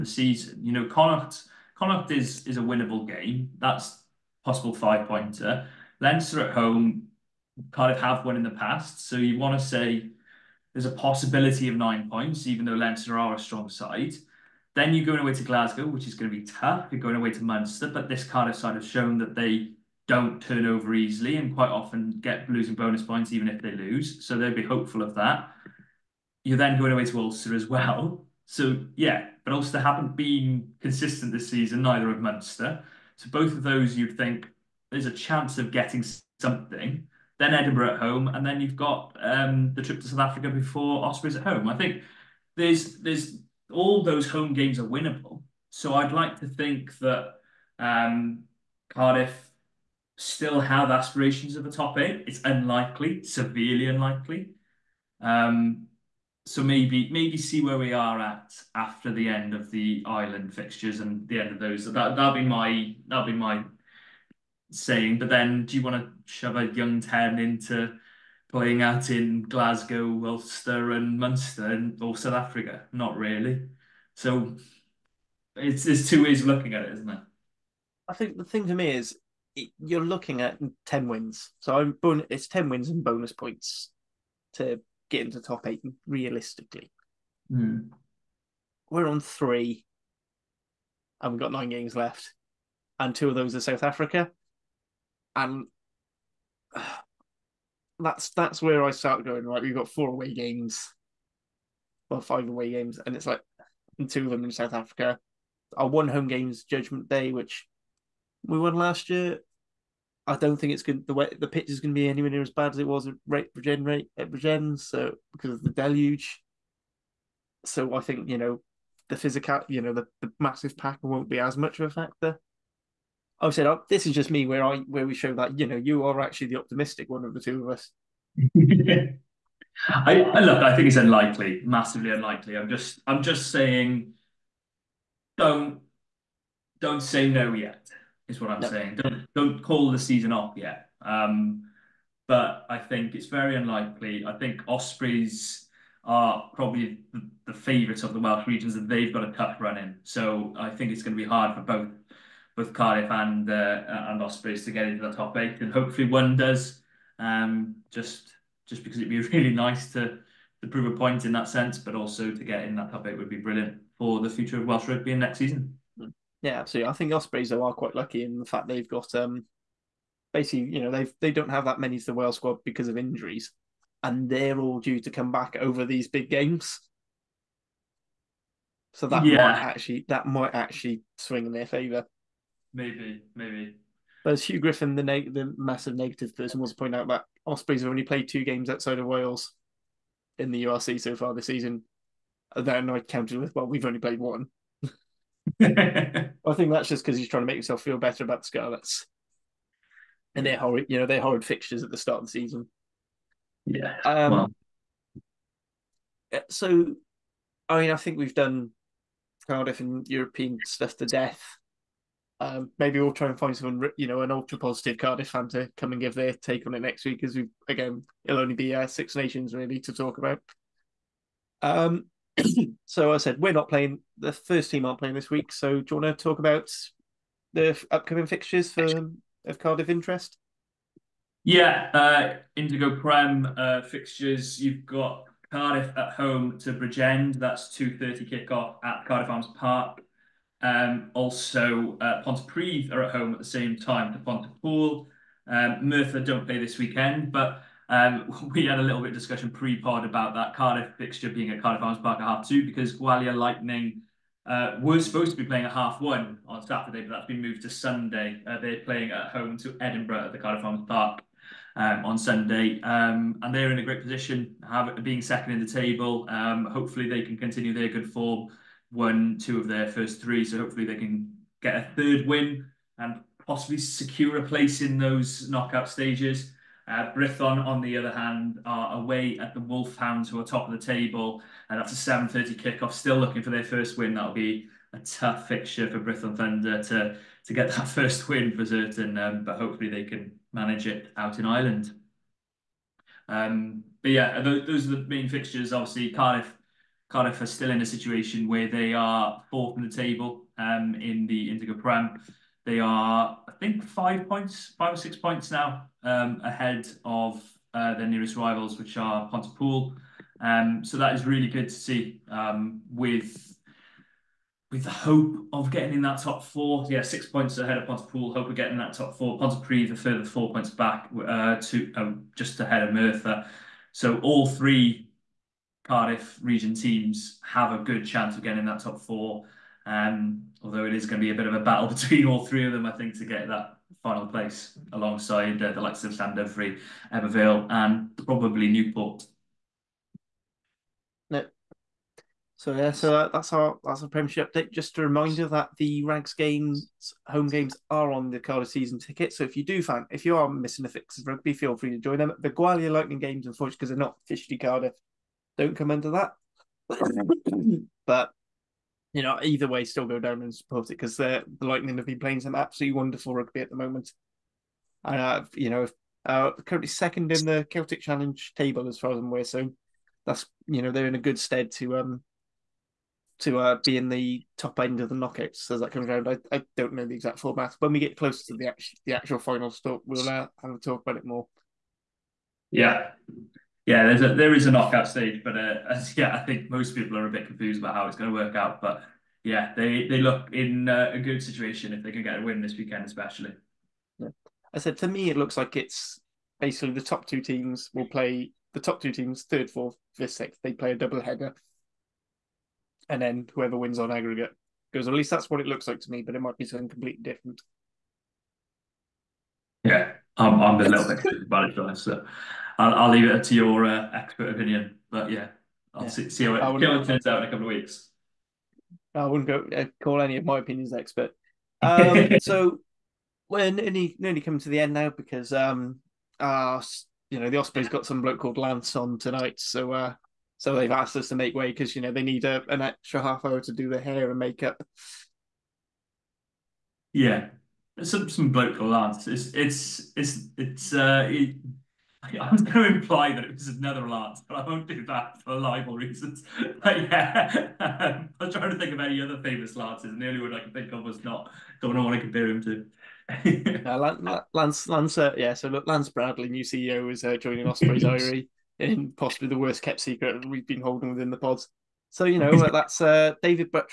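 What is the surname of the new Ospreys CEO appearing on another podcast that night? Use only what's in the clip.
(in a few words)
Bradley.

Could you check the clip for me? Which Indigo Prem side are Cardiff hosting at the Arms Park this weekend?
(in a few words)
Bridgend.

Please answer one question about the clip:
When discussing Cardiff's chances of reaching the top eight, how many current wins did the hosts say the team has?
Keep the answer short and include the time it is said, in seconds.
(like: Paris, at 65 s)
3, at 88 s.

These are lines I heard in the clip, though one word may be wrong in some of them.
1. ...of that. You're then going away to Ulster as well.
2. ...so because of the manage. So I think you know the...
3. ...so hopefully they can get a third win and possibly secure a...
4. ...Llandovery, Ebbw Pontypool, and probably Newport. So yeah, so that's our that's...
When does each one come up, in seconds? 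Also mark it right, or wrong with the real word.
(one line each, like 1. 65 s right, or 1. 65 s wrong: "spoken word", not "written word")
1. 25 s right
2. 114 s wrong: "deluge", not "manage"
3. 270 s right
4. 336 s wrong: "Vale", not "Pontypool".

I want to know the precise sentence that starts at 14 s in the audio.
Then you're going away to Glasgow, which is going to be tough.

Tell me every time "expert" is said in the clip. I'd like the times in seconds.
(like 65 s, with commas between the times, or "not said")
414 s, 420 s.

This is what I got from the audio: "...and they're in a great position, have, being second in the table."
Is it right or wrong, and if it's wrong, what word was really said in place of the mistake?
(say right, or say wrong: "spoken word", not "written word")
right.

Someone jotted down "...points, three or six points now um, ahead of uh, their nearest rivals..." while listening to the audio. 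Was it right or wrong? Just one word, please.
wrong.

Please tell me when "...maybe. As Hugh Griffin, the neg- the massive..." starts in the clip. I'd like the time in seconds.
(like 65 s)
183 s.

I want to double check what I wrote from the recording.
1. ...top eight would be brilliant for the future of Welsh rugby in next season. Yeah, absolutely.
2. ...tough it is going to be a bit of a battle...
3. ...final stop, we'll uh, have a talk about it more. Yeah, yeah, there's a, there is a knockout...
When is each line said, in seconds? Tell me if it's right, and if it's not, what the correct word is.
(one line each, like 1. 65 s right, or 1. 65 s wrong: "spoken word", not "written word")
1. 162 s right
2. 330 s wrong: "although", not "tough"
3. 379 s right.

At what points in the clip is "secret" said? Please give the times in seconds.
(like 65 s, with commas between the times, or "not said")
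460 s.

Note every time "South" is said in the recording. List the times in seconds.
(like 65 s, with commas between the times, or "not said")
40 s, 72 s, 93 s, 104 s.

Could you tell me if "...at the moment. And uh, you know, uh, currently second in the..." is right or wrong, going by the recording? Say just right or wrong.
right.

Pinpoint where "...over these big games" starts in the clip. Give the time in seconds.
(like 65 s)
175 s.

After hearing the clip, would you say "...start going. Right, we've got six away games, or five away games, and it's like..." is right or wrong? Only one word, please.
wrong.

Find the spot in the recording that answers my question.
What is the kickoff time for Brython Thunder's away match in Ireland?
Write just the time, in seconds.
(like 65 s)
282 s.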